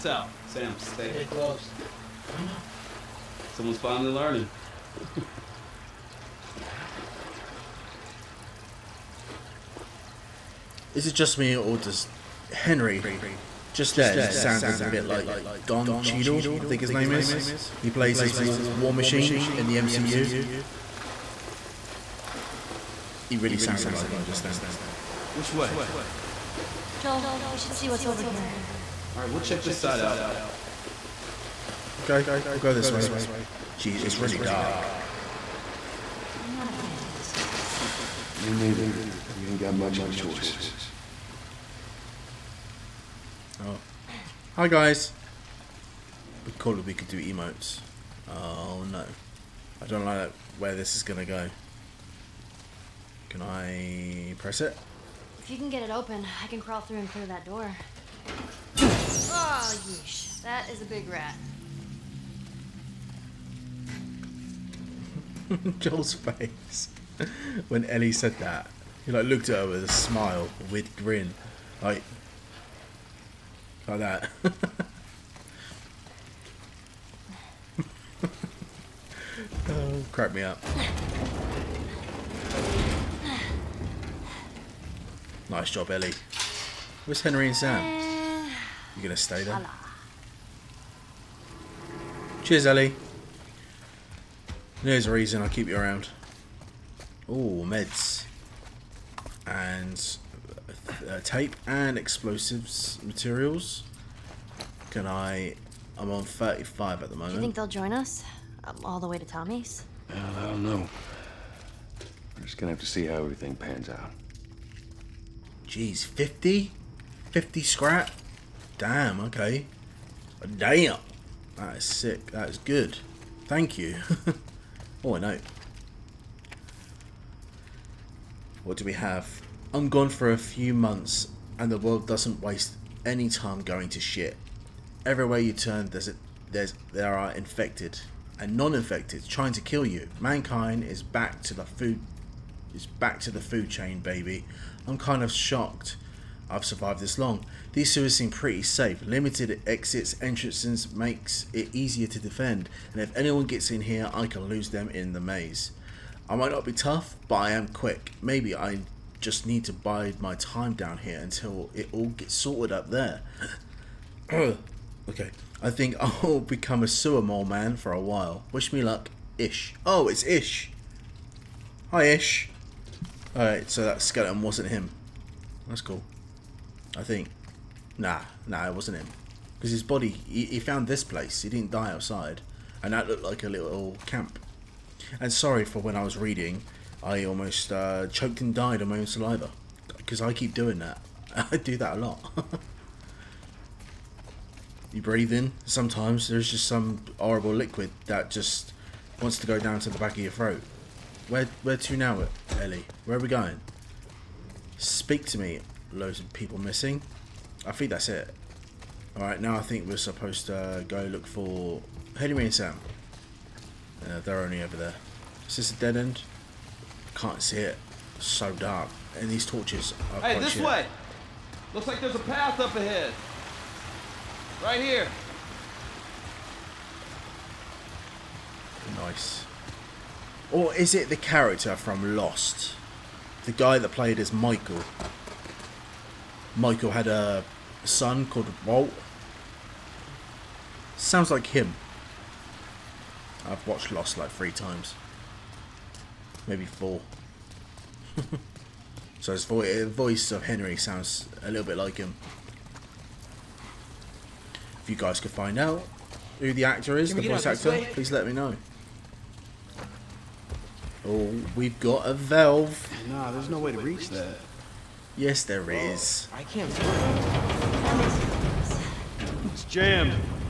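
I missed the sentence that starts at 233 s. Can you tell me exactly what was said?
The guy that played as Michael.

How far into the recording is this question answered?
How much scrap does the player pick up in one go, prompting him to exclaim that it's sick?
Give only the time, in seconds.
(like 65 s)
117 s.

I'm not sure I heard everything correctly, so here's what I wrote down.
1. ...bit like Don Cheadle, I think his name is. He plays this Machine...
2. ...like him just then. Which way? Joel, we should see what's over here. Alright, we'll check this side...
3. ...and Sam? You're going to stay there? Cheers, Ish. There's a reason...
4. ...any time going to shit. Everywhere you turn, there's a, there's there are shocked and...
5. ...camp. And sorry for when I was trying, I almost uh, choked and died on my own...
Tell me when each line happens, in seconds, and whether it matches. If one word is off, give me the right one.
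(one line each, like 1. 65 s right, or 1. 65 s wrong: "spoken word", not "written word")
1. 14 s wrong: "War", not "Machine"
2. 23 s right
3. 87 s wrong: "Ellie", not "Ish"
4. 133 s wrong: "infected", not "shocked"
5. 184 s wrong: "reading", not "trying".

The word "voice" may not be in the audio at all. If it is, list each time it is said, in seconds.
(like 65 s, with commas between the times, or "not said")
249 s, 257 s.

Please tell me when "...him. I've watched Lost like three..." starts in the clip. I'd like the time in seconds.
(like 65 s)
241 s.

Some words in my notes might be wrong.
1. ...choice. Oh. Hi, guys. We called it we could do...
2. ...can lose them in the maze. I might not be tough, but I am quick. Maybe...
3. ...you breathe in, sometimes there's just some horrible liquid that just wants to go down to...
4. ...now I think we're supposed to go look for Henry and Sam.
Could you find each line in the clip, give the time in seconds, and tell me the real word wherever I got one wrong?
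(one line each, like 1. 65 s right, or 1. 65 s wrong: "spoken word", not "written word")
1. 40 s right
2. 154 s right
3. 194 s right
4. 209 s right.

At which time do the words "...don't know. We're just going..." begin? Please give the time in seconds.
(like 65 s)
110 s.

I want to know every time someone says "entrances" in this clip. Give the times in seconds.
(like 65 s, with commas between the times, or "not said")
150 s.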